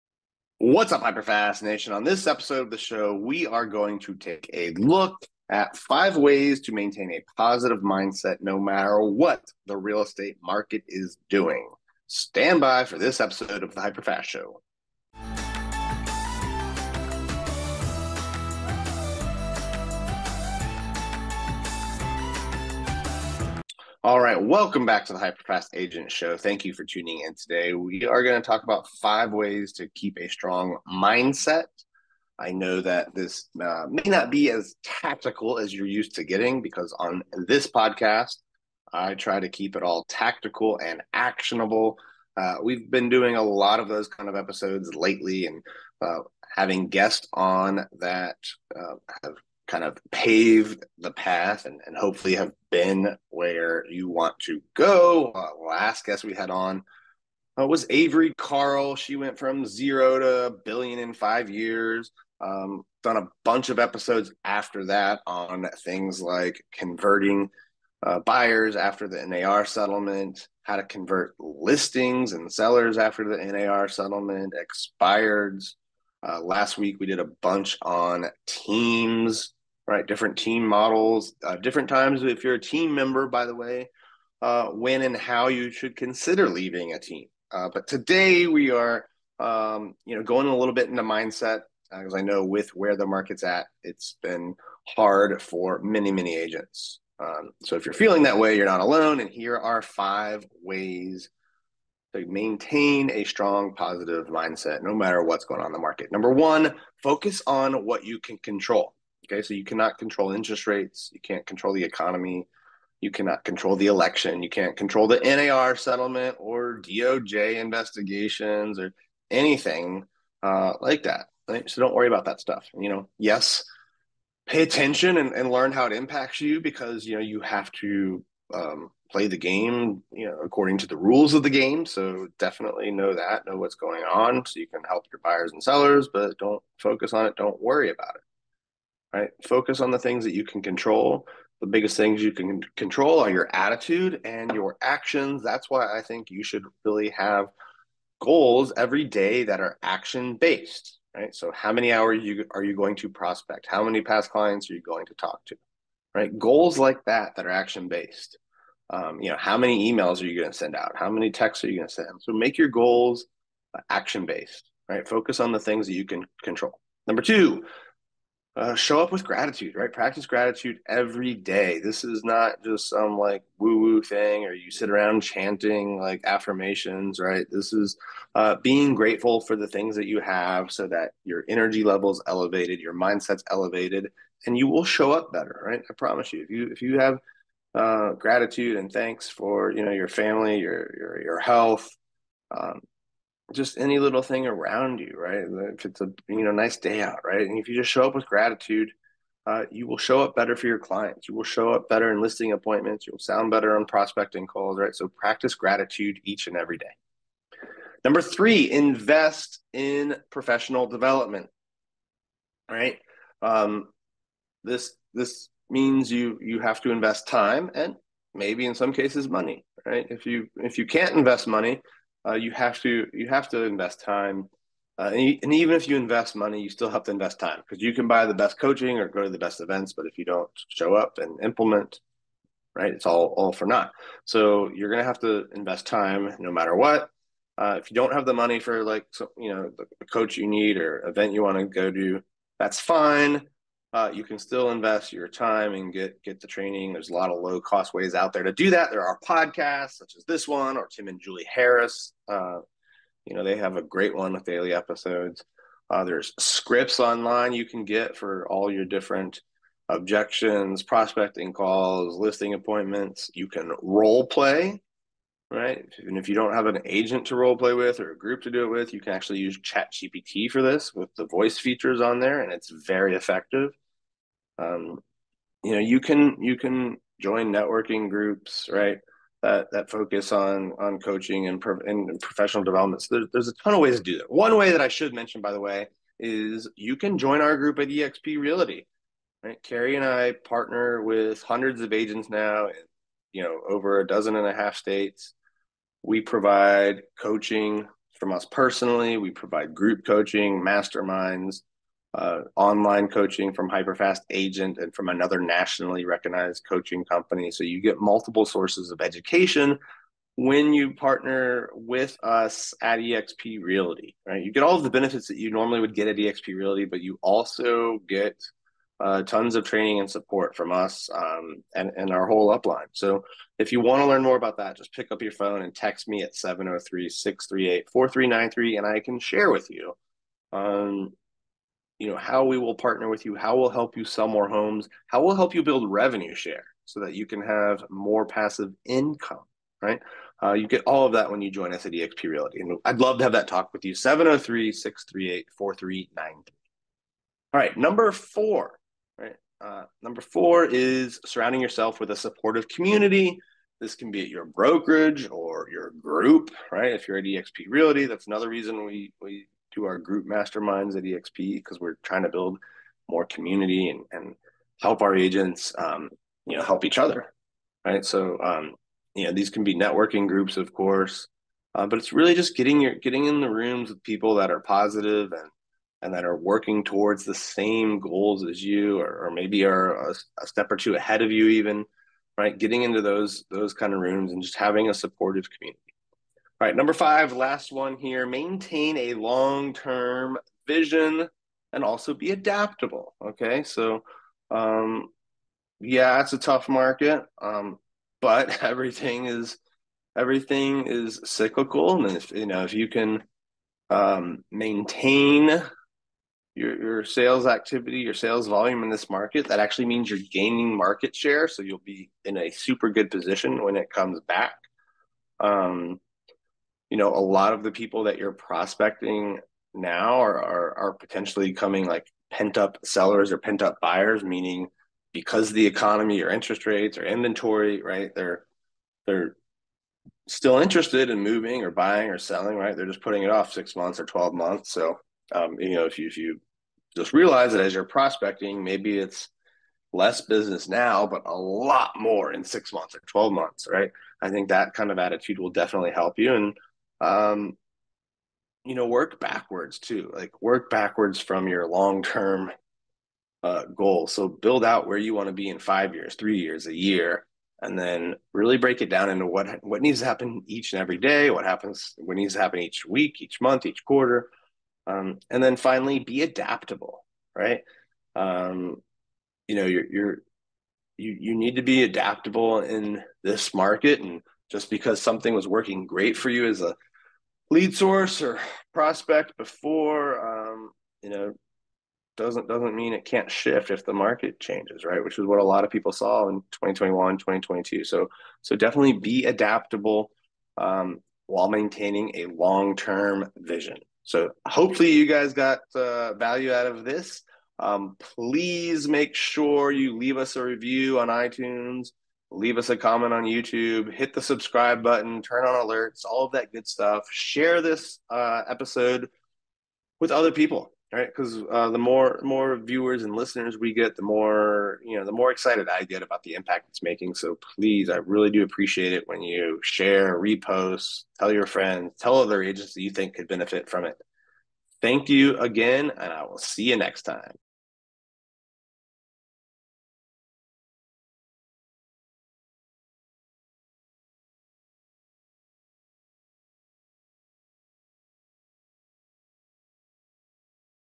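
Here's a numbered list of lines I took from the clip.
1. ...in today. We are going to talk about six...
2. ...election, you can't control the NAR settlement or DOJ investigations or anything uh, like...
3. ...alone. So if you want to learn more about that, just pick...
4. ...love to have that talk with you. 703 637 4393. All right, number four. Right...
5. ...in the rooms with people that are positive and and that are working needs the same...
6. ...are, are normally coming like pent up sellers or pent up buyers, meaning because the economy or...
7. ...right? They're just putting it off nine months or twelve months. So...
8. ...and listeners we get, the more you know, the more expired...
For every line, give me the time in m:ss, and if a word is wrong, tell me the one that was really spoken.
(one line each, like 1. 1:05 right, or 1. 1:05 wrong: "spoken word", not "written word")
1. 0:27 wrong: "five", not "six"
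2. 1:53 right
3. 5:22 wrong: "upline", not "alone"
4. 5:42 wrong: "638", not "637"
5. 6:13 wrong: "towards", not "needs"
6. 7:00 wrong: "potentially", not "normally"
7. 7:12 wrong: "six", not "nine"
8. 8:33 wrong: "excited", not "expired".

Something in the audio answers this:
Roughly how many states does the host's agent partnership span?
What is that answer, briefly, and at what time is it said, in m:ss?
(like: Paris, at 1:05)
over a dozen and a half, at 4:53.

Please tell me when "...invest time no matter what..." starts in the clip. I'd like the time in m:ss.
3:55.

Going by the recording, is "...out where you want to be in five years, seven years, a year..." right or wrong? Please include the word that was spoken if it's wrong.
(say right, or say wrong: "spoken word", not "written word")
wrong: "three", not "seven".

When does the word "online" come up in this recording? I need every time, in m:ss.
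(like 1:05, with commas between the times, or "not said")
4:17, 5:02.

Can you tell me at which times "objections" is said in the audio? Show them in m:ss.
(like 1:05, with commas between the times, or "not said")
4:19.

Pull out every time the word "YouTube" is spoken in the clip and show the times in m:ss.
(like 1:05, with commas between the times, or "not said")
8:23.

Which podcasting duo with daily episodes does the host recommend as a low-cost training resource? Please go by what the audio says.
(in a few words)
Tim and Julie Harris.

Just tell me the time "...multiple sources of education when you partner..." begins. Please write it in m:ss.
5:08.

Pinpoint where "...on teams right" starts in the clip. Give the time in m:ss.
1:17.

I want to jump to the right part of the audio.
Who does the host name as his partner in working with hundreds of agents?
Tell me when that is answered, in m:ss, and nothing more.
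4:49.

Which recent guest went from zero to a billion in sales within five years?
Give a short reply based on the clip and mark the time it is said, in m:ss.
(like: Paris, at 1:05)
Avery Carl, at 0:57.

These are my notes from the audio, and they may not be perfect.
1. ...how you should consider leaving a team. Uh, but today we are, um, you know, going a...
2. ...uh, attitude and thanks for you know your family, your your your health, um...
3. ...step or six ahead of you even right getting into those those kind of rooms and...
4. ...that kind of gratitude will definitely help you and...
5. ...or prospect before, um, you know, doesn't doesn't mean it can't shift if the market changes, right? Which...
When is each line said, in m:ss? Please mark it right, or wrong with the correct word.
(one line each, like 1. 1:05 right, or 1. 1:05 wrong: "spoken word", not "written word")
1. 1:25 right
2. 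3:07 wrong: "gratitude", not "attitude"
3. 6:20 wrong: "two", not "six"
4. 7:24 wrong: "attitude", not "gratitude"
5. 7:58 right.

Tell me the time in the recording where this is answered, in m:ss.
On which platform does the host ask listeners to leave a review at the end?
8:21.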